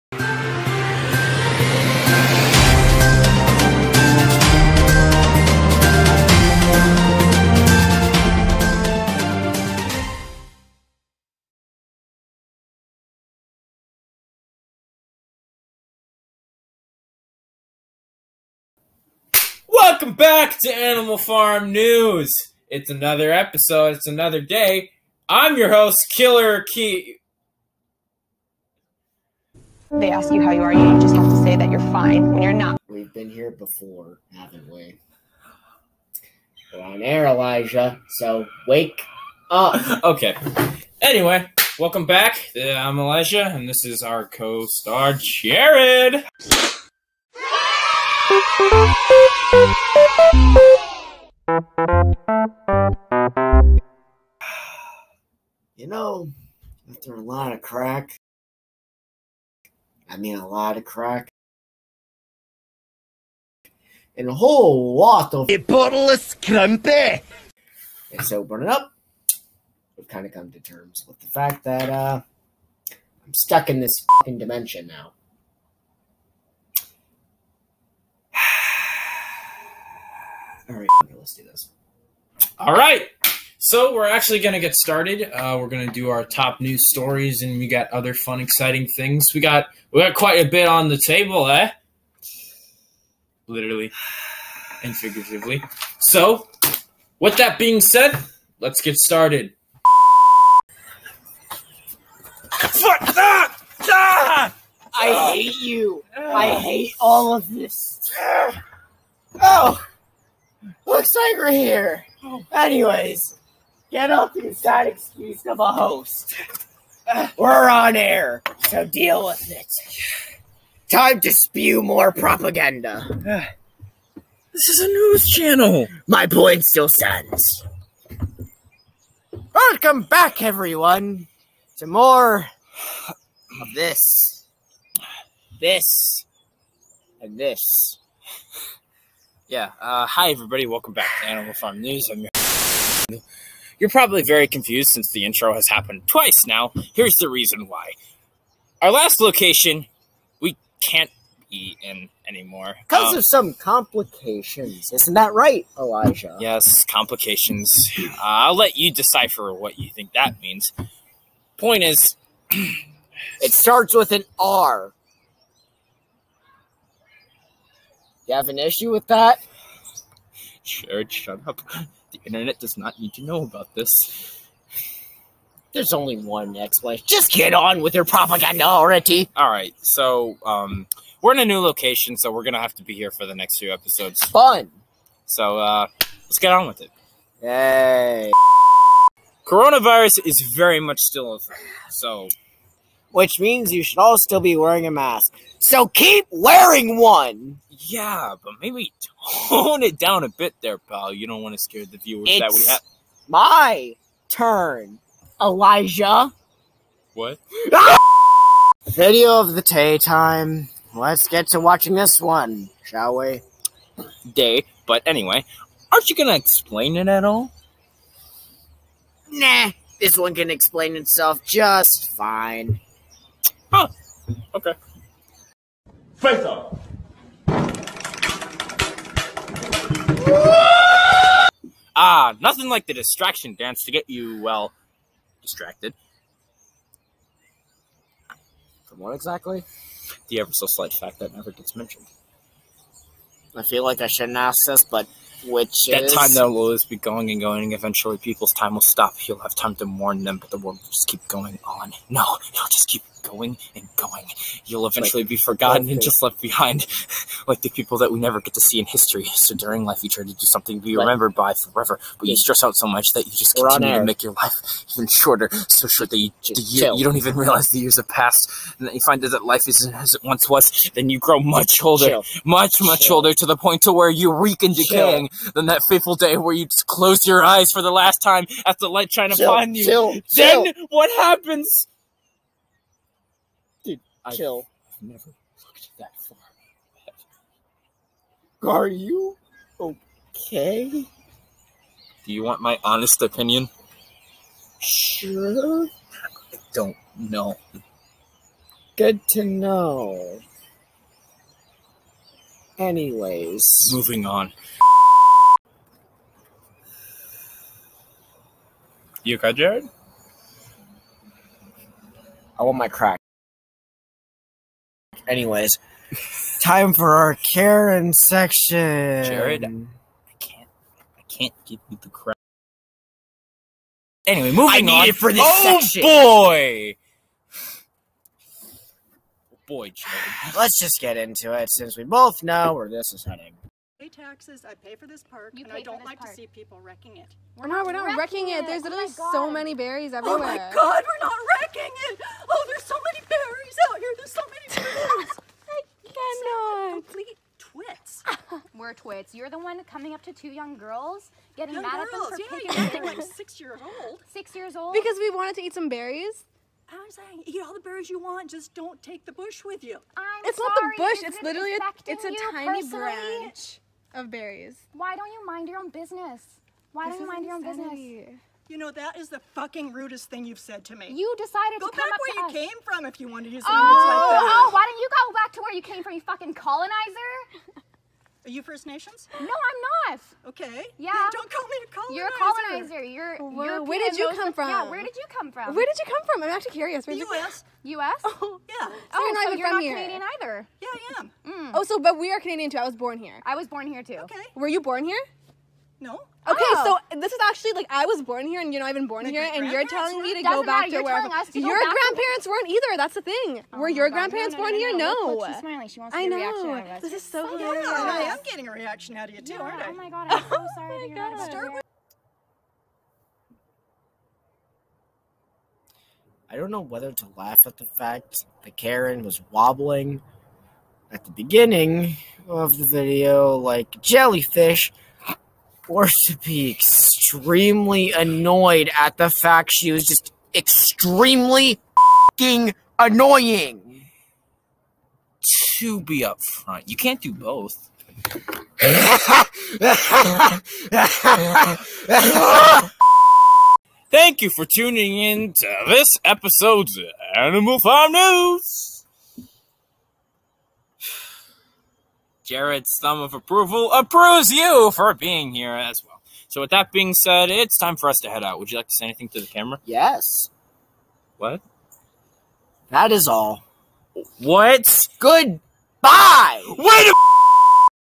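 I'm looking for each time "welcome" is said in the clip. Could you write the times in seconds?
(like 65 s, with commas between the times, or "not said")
20 s, 41 s, 129 s, 140 s.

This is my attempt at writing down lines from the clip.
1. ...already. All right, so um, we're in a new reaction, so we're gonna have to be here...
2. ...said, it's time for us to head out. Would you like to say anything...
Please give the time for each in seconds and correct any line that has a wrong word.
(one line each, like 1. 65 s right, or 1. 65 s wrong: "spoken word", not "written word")
1. 178 s wrong: "location", not "reaction"
2. 457 s right.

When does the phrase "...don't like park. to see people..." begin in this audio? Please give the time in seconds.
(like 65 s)
335 s.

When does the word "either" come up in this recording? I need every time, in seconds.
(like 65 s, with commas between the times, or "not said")
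390 s, 402 s.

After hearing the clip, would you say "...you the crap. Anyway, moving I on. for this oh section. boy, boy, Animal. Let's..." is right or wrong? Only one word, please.
wrong.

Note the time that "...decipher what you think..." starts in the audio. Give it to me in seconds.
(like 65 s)
158 s.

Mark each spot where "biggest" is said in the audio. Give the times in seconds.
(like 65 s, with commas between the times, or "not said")
not said.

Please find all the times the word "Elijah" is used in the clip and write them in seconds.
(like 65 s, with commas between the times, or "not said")
37 s, 42 s, 155 s, 205 s.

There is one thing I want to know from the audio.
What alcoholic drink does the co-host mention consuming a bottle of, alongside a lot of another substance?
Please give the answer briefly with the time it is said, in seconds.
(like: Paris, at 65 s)
scrumpy, at 66 s.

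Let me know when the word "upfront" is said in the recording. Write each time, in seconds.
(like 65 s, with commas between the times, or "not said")
436 s.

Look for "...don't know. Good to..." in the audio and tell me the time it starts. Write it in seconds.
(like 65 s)
296 s.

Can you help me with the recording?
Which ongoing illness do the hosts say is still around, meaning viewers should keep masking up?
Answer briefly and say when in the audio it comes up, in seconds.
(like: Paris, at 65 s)
Coronavirus, at 189 s.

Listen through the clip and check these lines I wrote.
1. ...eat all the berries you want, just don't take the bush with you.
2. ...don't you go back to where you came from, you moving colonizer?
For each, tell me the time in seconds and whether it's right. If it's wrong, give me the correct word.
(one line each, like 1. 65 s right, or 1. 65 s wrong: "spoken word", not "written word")
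1. 357 s right
2. 374 s wrong: "fucking", not "moving".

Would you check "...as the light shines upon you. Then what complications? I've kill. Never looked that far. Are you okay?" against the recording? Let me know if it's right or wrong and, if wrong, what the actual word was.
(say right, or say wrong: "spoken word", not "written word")
wrong: "happens", not "complications".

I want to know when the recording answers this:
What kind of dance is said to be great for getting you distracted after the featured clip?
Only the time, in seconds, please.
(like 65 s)
232 s.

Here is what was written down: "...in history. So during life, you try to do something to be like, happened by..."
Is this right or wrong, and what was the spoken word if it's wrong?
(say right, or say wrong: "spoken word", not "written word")
wrong: "remembered", not "happened".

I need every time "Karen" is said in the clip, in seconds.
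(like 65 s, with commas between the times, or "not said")
317 s, 418 s.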